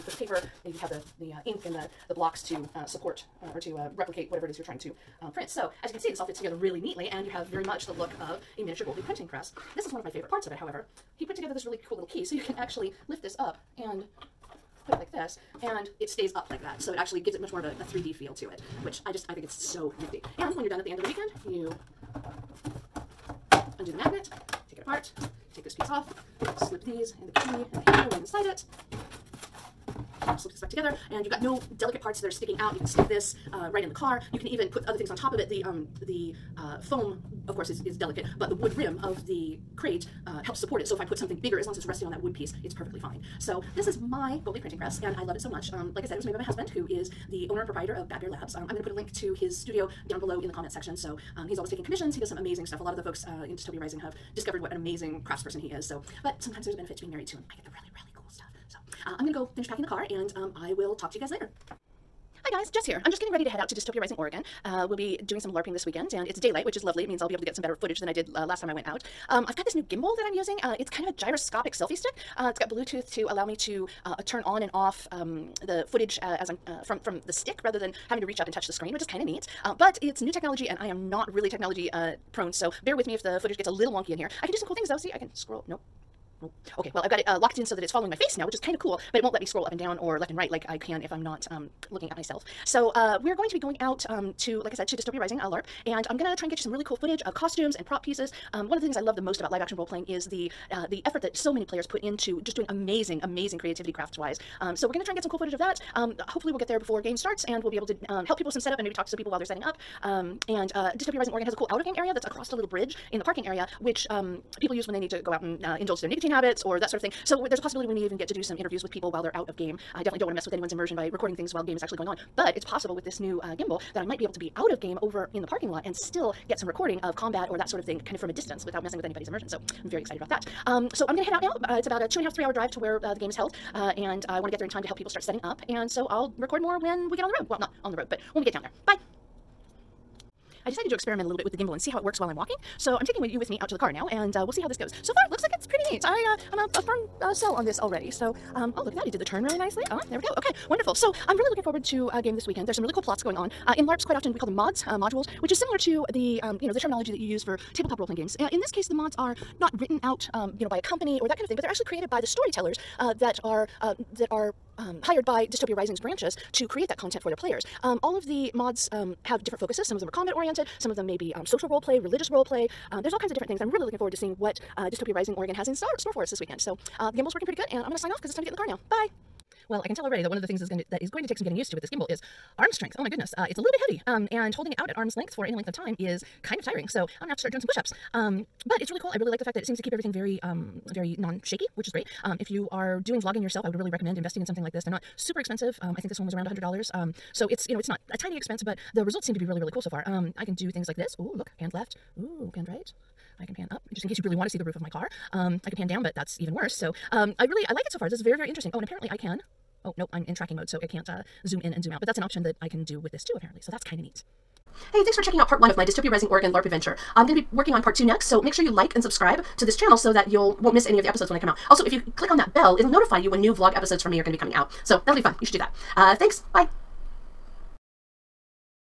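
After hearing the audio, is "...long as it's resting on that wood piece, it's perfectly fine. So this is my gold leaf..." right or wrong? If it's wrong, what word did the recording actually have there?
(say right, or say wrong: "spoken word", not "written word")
right.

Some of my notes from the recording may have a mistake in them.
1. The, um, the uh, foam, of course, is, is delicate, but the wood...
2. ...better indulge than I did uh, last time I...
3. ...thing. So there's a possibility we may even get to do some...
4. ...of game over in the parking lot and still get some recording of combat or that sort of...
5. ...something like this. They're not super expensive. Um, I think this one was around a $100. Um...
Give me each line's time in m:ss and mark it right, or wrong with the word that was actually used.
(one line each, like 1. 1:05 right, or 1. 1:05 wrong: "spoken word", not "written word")
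1. 0:35 right
2. 1:07 wrong: "footage", not "indulge"
3. 1:57 right
4. 2:04 right
5. 3:14 right.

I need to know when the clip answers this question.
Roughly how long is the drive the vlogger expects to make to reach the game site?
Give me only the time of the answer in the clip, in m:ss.
2:12.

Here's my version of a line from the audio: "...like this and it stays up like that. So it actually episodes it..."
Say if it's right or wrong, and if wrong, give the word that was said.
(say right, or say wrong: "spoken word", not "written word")
wrong: "gives", not "episodes".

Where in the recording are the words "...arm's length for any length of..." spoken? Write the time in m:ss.
3:04.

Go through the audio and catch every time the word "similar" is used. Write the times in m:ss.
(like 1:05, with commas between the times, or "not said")
2:35.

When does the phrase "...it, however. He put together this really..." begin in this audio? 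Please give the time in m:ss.
0:10.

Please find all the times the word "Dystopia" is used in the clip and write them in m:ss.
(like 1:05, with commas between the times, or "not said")
0:53, 1:03, 1:34, 1:50, 2:45, 2:54, 3:35.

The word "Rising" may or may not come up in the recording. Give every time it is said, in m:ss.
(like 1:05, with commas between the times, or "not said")
0:53, 1:03, 1:35, 1:51, 2:45, 2:55, 3:36.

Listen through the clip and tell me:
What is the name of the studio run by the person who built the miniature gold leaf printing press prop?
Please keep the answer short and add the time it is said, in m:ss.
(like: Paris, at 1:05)
Bad Bear Labs, at 0:48.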